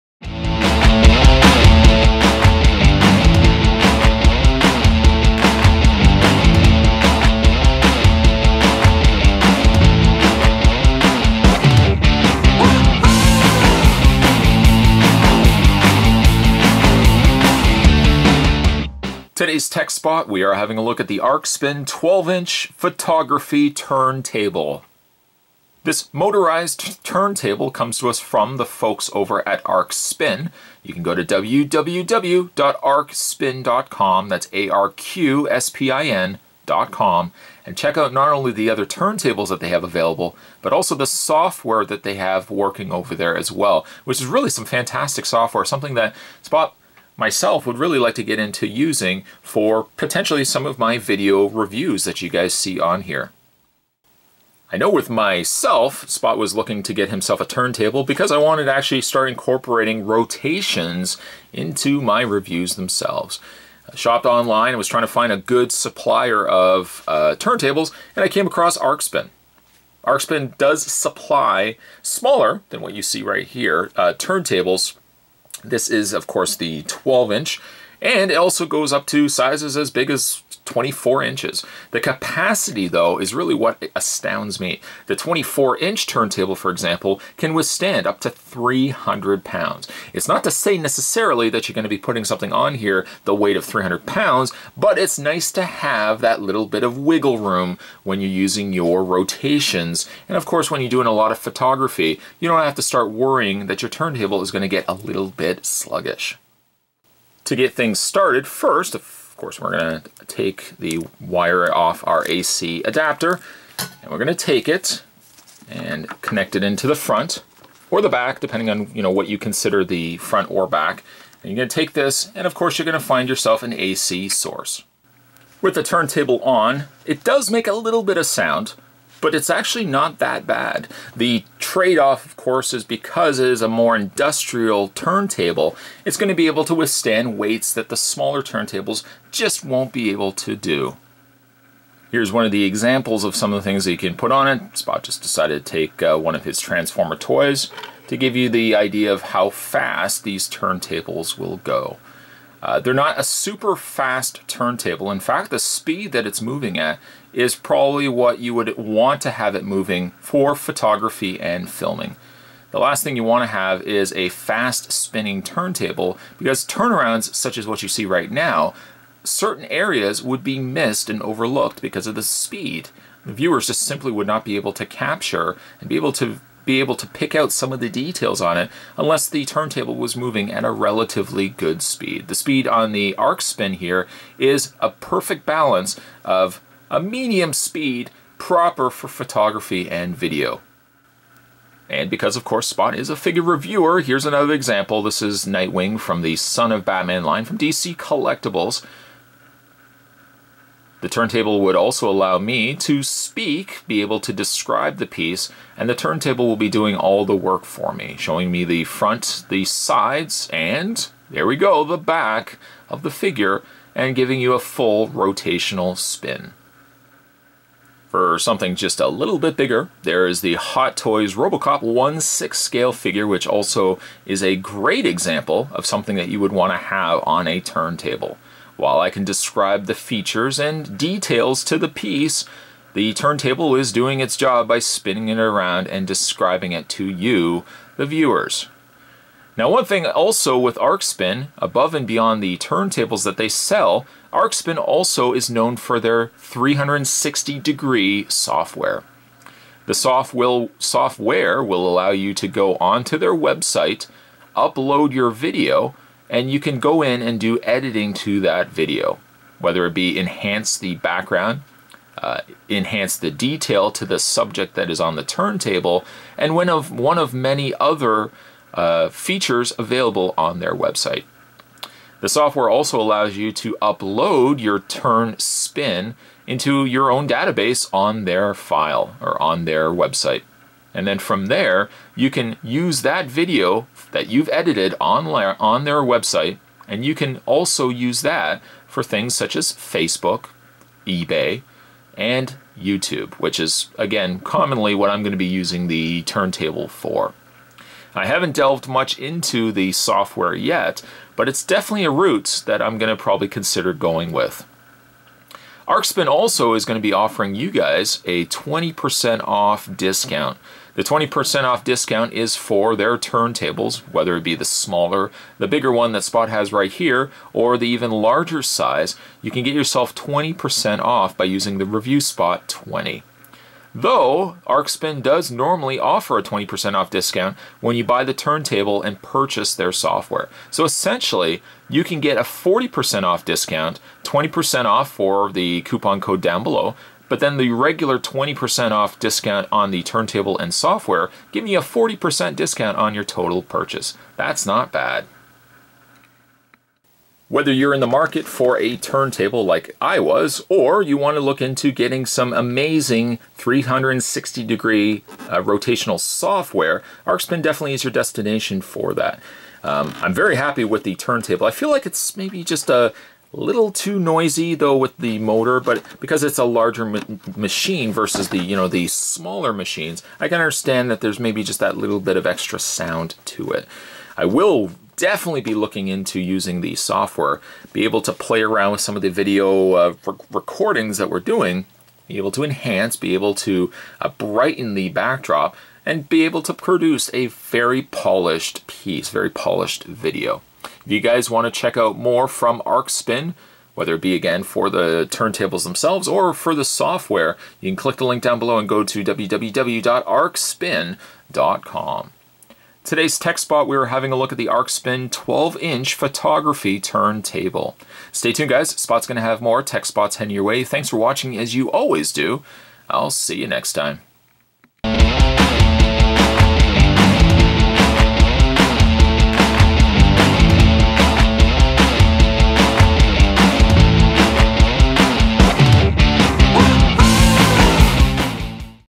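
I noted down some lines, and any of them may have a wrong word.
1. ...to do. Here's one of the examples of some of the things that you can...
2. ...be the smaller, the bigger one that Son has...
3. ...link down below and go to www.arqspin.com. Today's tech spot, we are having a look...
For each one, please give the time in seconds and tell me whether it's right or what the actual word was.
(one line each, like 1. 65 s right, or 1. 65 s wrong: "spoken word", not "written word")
1. 140 s right
2. 314 s wrong: "Spot", not "Son"
3. 398 s right.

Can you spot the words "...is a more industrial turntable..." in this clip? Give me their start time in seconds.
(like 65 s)
133 s.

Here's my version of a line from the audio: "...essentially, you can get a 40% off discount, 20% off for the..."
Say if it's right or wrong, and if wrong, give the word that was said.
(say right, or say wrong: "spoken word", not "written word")
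right.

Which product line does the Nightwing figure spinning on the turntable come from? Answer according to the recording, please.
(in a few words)
Son of Batman.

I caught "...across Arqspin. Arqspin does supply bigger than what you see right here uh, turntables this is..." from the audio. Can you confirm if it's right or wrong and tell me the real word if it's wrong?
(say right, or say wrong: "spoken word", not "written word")
wrong: "smaller", not "bigger".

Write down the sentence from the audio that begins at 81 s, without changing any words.
The capacity, though, is really what astounds me.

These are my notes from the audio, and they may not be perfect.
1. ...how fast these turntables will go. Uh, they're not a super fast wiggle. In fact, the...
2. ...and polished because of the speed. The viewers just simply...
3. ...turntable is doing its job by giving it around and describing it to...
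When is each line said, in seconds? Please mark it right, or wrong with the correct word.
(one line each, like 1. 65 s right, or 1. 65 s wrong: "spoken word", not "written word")
1. 149 s wrong: "turntable", not "wiggle"
2. 171 s wrong: "overlooked", not "polished"
3. 233 s wrong: "spinning", not "giving".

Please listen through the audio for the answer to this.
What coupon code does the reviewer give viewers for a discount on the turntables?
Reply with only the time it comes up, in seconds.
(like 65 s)
321 s.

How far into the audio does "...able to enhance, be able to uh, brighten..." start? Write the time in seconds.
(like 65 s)
382 s.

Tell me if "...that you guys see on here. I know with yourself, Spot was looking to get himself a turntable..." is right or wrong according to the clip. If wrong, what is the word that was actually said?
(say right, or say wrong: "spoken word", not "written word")
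wrong: "myself", not "yourself".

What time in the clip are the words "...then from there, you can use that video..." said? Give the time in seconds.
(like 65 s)
281 s.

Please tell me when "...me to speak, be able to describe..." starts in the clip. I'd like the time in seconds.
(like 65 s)
202 s.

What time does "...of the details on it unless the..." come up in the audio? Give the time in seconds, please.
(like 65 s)
177 s.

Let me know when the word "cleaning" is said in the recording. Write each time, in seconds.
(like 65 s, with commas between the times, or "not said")
not said.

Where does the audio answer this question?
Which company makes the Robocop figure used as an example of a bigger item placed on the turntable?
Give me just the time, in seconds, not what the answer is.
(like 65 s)
220 s.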